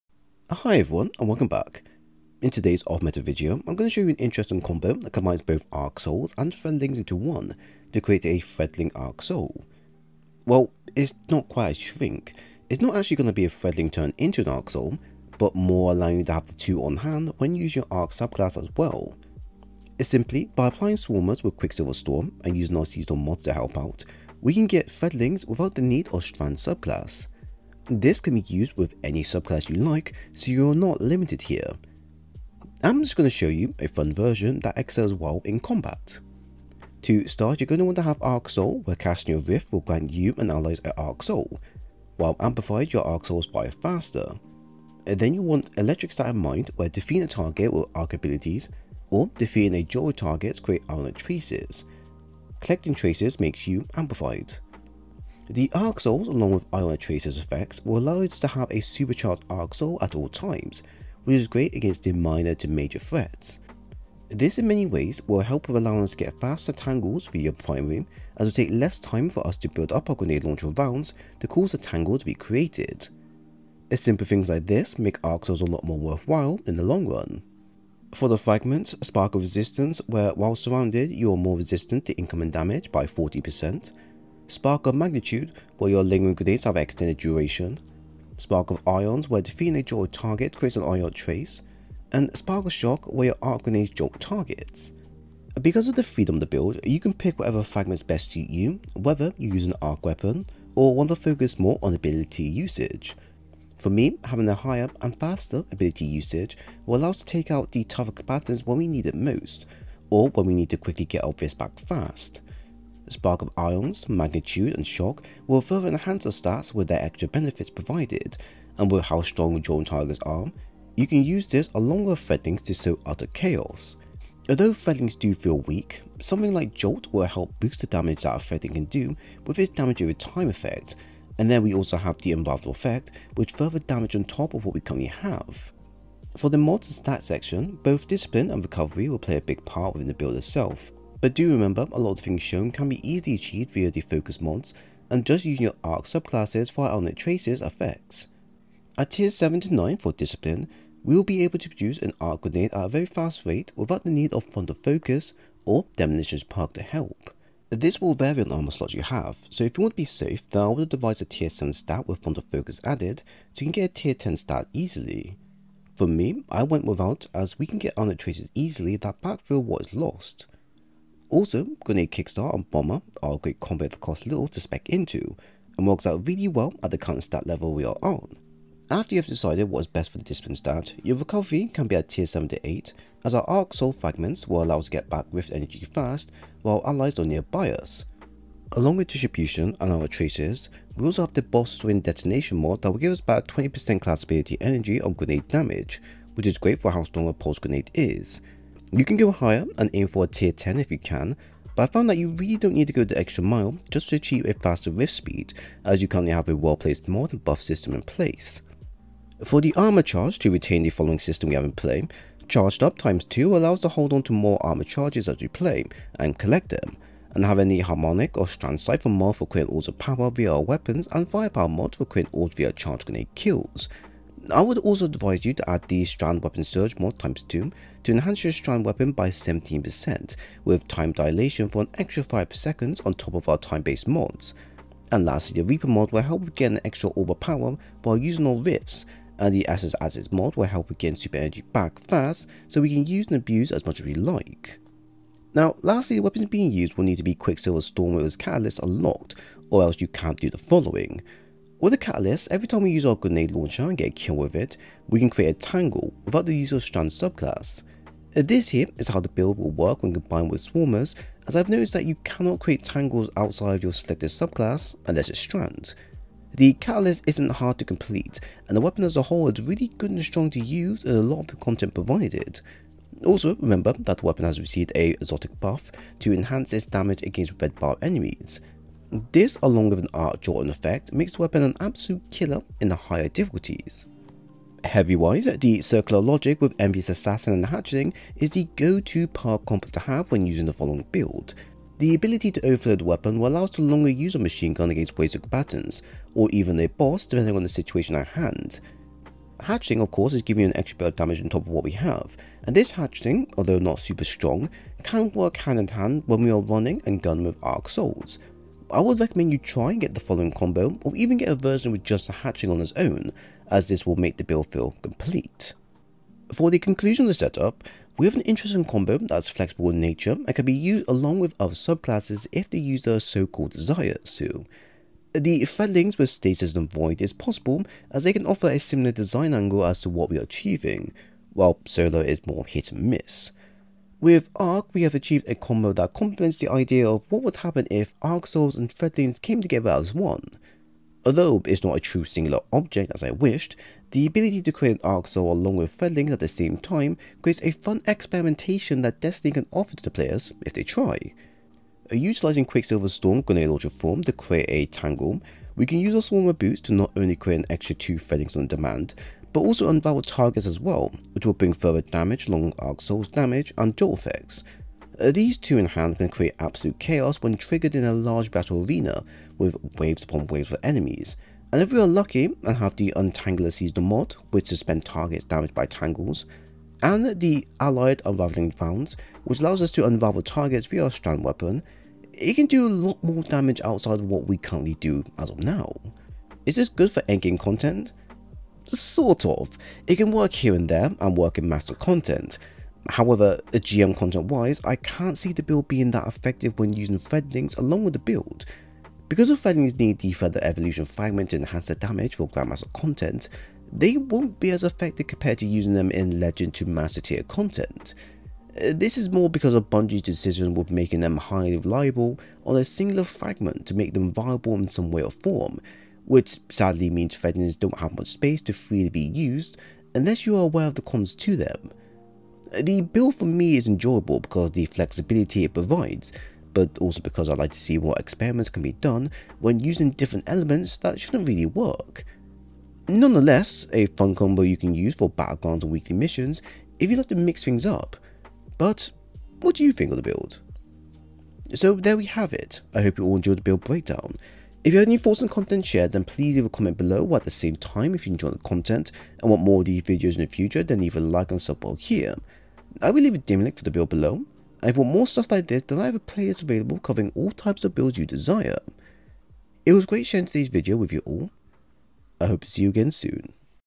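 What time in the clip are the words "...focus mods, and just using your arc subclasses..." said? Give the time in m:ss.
2:24.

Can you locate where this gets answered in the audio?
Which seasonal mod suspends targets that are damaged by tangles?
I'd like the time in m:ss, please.
6:13.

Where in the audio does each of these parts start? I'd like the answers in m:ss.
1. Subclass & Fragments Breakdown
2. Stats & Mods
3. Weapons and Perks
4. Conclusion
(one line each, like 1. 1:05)
1. 0:38
2. 2:17
3. 4:07
4. 5:16.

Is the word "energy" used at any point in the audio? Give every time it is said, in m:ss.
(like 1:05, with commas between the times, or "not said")
3:05, 3:14, 4:01.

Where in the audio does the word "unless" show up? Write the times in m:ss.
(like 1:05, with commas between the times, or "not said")
4:25, 7:00.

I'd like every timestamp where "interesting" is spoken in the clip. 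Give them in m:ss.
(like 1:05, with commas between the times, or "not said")
0:04, 5:18.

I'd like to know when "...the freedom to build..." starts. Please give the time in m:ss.
1:35.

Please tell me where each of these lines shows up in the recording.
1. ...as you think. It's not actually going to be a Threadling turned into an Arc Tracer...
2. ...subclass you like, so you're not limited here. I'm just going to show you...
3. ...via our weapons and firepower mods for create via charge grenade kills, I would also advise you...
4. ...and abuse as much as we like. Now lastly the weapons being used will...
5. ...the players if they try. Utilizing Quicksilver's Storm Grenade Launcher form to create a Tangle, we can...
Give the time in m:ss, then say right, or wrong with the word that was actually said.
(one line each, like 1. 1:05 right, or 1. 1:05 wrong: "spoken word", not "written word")
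1. 0:11 wrong: "Soul", not "Tracer"
2. 0:29 right
3. 3:40 right
4. 4:03 right
5. 5:50 right.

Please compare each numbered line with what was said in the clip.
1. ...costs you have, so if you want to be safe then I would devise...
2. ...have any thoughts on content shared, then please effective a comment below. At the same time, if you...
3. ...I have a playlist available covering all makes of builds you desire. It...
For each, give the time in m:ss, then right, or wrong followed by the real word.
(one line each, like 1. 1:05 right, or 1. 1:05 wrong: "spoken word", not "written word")
1. 2:38 wrong: "slots", not "costs"
2. 7:24 wrong: "leave", not "effective"
3. 7:35 wrong: "types", not "makes".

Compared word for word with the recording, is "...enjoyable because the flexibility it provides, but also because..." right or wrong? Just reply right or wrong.
right.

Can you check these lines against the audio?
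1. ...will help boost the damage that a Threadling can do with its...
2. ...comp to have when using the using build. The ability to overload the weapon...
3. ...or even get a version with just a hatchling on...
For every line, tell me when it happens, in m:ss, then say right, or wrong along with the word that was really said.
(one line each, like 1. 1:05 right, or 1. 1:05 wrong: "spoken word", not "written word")
1. 2:07 right
2. 4:49 wrong: "following", not "using"
3. 5:11 right.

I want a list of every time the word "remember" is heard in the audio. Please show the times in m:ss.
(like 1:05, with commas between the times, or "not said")
2:21, 4:33.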